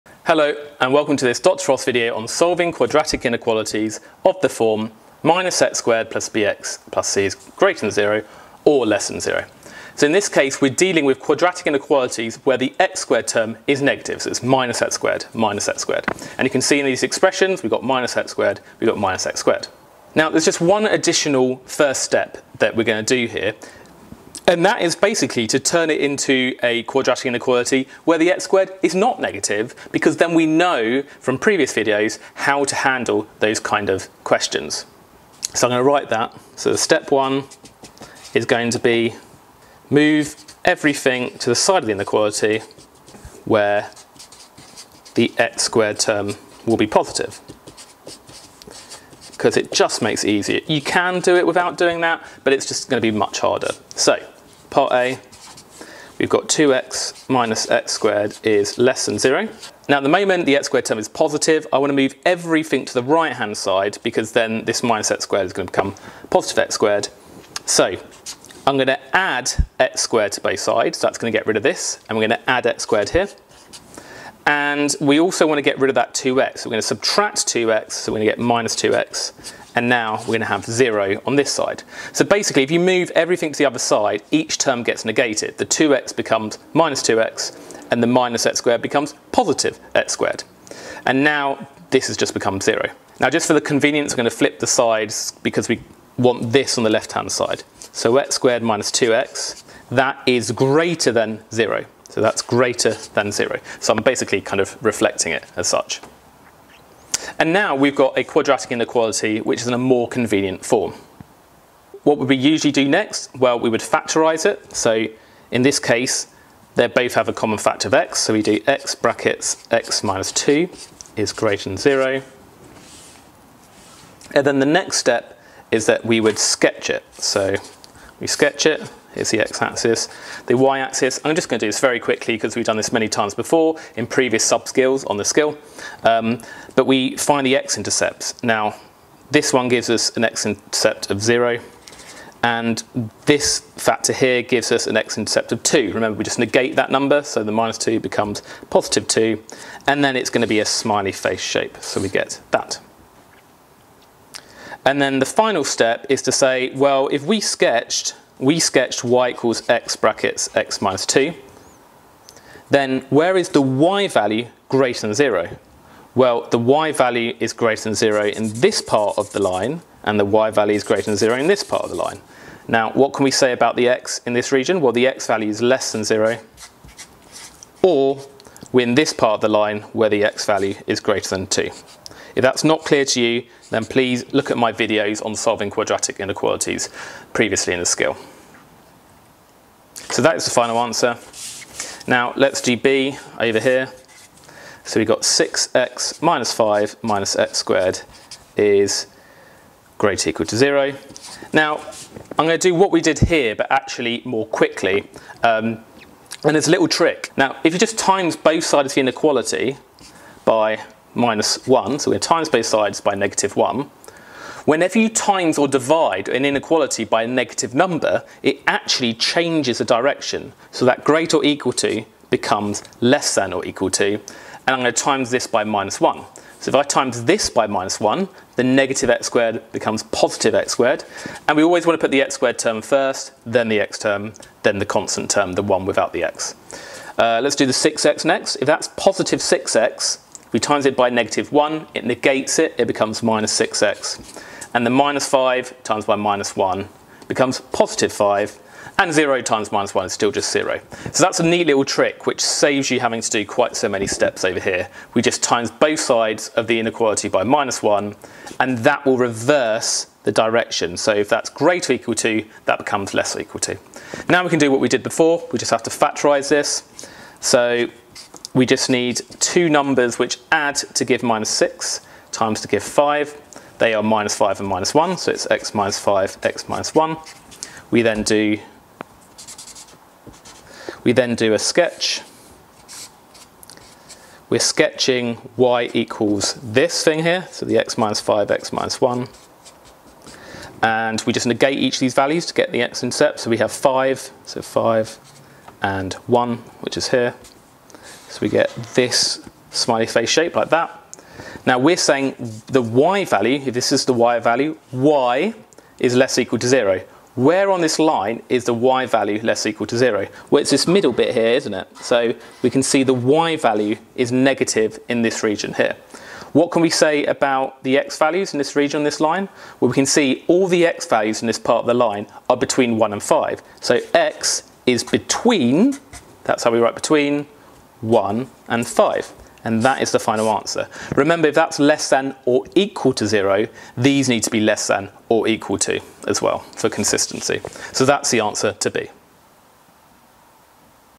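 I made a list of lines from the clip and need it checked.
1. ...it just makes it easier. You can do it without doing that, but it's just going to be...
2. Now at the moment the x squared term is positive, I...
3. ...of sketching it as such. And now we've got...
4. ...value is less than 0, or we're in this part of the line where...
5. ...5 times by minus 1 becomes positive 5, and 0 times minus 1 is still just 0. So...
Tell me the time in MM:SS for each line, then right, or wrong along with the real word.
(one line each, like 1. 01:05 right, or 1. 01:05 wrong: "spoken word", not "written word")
1. 00:49 right
2. 00:59 right
3. 01:44 wrong: "reflecting", not "sketching"
4. 02:55 right
5. 04:05 right.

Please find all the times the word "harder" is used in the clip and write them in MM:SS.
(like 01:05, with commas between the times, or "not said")
00:53.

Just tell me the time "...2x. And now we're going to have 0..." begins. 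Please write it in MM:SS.
01:18.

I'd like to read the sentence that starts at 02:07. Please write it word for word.
So we sketch it is the x-axis.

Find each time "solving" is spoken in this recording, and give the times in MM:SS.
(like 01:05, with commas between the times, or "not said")
00:02, 03:05.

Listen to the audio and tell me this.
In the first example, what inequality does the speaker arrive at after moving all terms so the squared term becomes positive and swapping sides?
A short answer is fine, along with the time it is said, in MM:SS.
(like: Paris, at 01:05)
x squared minus 2x > 0, at 01:38.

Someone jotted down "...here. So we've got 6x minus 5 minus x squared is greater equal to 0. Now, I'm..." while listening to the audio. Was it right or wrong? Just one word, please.
right.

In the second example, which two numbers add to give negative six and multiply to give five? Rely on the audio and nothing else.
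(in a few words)
-5 and -1.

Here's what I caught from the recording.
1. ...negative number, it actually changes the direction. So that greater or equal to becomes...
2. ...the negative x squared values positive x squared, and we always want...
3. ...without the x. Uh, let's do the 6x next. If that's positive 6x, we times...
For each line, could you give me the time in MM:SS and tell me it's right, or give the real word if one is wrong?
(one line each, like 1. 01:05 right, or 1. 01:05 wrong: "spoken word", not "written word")
1. 03:37 right
2. 03:48 wrong: "becomes", not "values"
3. 03:55 right.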